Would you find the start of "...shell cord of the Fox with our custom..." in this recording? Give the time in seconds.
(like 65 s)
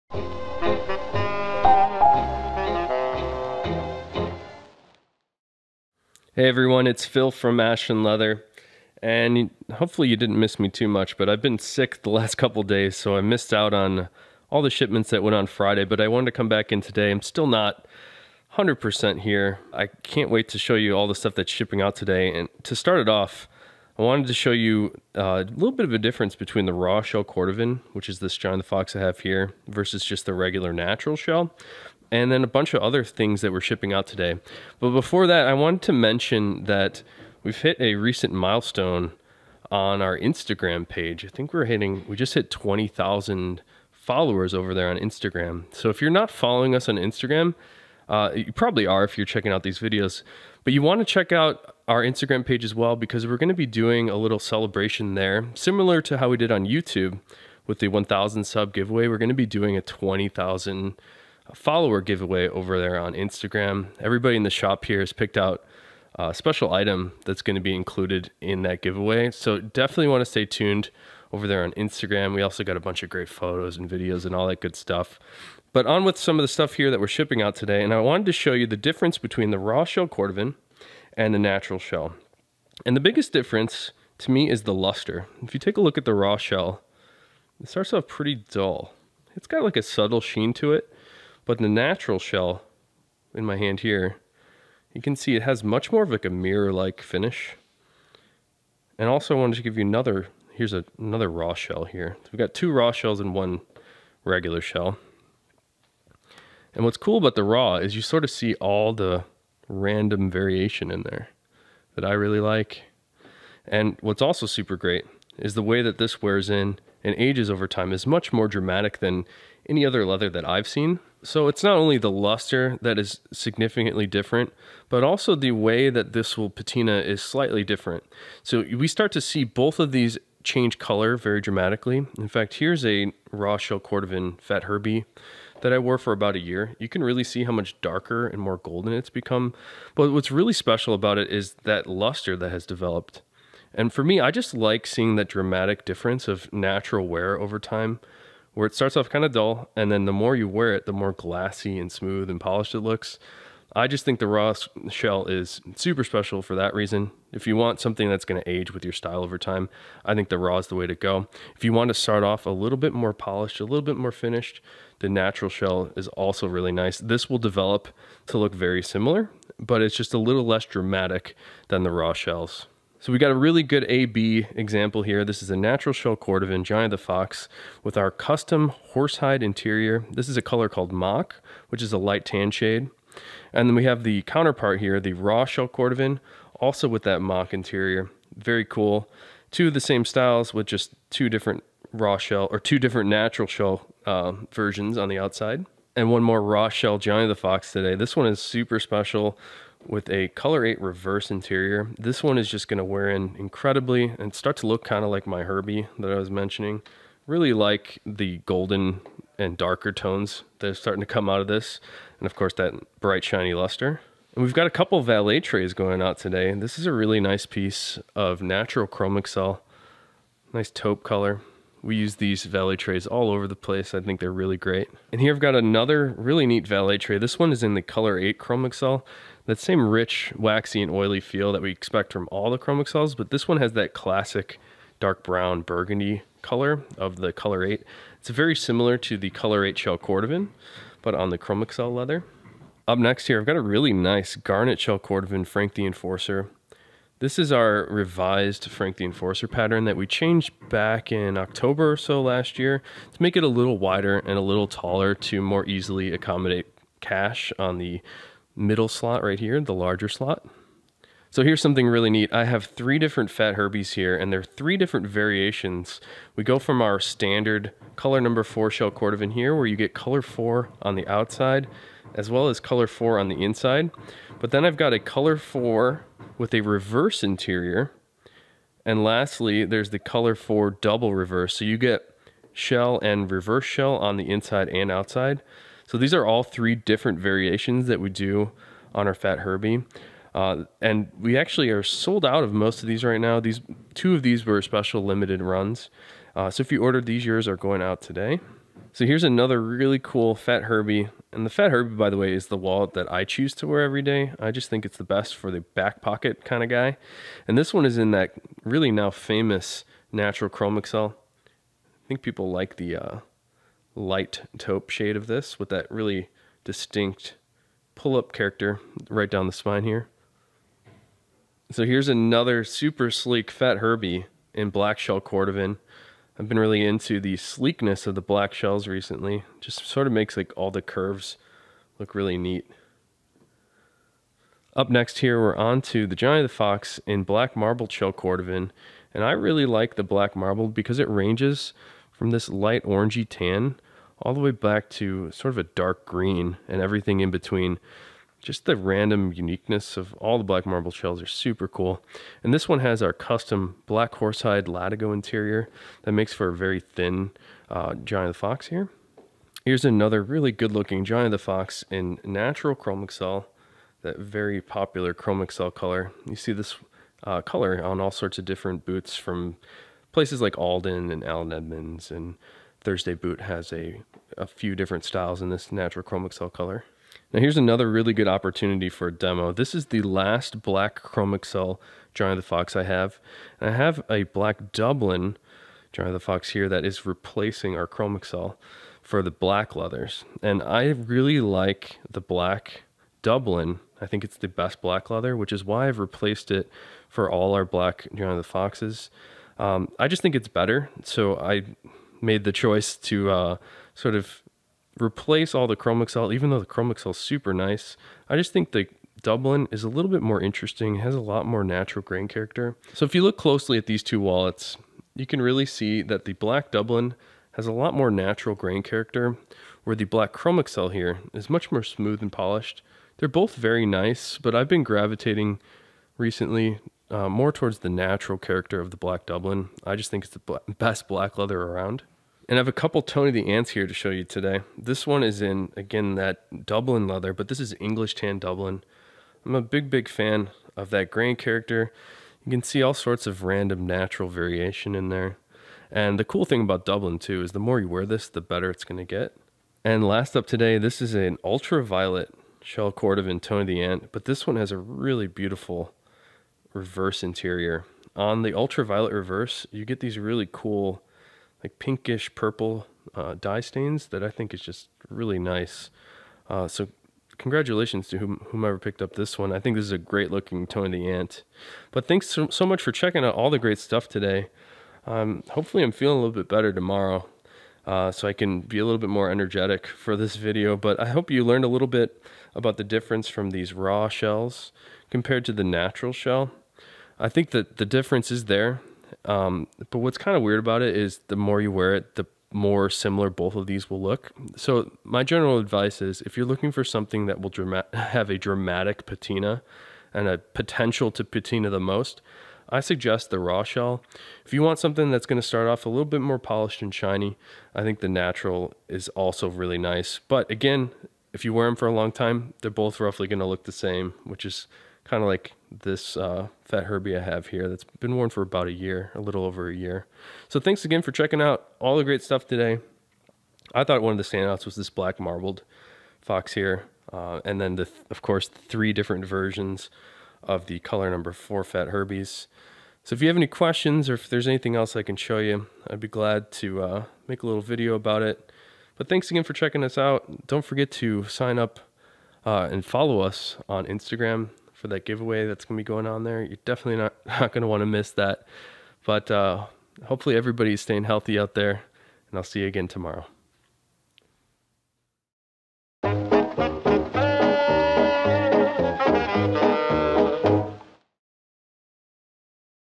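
175 s.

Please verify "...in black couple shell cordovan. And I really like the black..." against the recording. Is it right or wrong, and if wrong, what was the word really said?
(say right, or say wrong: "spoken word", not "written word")
wrong: "marble", not "couple".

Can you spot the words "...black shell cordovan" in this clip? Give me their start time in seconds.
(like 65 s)
324 s.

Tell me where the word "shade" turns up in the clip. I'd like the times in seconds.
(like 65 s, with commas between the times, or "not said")
182 s, 314 s.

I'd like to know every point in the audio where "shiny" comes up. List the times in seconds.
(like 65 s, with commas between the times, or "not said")
213 s, 506 s.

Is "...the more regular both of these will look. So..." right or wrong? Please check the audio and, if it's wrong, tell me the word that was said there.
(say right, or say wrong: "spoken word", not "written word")
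wrong: "similar", not "regular".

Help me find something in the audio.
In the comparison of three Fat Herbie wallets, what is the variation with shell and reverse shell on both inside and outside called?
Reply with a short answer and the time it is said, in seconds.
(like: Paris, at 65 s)
Double reverse, at 280 s.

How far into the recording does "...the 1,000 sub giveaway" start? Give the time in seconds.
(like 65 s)
57 s.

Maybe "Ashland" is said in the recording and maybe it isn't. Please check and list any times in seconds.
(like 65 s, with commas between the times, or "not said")
7 s.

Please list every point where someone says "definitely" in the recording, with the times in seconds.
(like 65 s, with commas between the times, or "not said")
69 s, 546 s.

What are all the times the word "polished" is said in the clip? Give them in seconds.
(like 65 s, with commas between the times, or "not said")
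152 s, 163 s, 422 s, 506 s.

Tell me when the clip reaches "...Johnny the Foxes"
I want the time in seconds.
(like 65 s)
398 s.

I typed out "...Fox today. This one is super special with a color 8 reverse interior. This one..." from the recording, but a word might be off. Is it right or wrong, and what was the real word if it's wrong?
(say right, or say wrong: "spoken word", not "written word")
right.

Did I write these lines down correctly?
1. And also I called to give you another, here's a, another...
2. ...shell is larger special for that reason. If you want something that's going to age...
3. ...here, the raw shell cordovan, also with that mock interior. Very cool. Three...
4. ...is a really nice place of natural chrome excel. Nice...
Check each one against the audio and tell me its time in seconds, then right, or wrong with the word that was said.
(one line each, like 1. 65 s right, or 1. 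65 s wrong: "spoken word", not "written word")
1. 98 s wrong: "wanted", not "called"
2. 154 s wrong: "super", not "larger"
3. 184 s wrong: "Two", not "Three"
4. 216 s wrong: "piece", not "place".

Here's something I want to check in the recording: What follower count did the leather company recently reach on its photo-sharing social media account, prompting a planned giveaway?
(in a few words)
20,000.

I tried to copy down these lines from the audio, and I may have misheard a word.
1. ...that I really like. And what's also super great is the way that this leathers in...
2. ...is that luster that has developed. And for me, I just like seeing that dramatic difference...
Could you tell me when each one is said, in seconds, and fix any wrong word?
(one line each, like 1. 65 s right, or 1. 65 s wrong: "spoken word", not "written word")
1. 111 s wrong: "wears", not "leathers"
2. 141 s right.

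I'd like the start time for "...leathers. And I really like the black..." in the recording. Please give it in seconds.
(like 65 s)
389 s.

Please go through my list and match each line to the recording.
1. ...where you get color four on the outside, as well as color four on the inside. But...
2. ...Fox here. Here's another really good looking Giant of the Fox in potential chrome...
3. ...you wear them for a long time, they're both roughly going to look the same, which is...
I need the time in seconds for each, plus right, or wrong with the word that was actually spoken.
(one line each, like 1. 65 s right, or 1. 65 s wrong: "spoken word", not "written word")
1. 269 s right
2. 358 s wrong: "natural", not "potential"
3. 511 s right.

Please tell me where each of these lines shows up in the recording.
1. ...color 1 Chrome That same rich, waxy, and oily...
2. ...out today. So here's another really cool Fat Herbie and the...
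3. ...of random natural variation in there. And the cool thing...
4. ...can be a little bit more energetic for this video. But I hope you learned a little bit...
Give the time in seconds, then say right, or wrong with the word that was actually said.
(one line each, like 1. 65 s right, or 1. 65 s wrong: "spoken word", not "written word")
1. 227 s wrong: "8", not "1"
2. 297 s right
3. 443 s right
4. 478 s right.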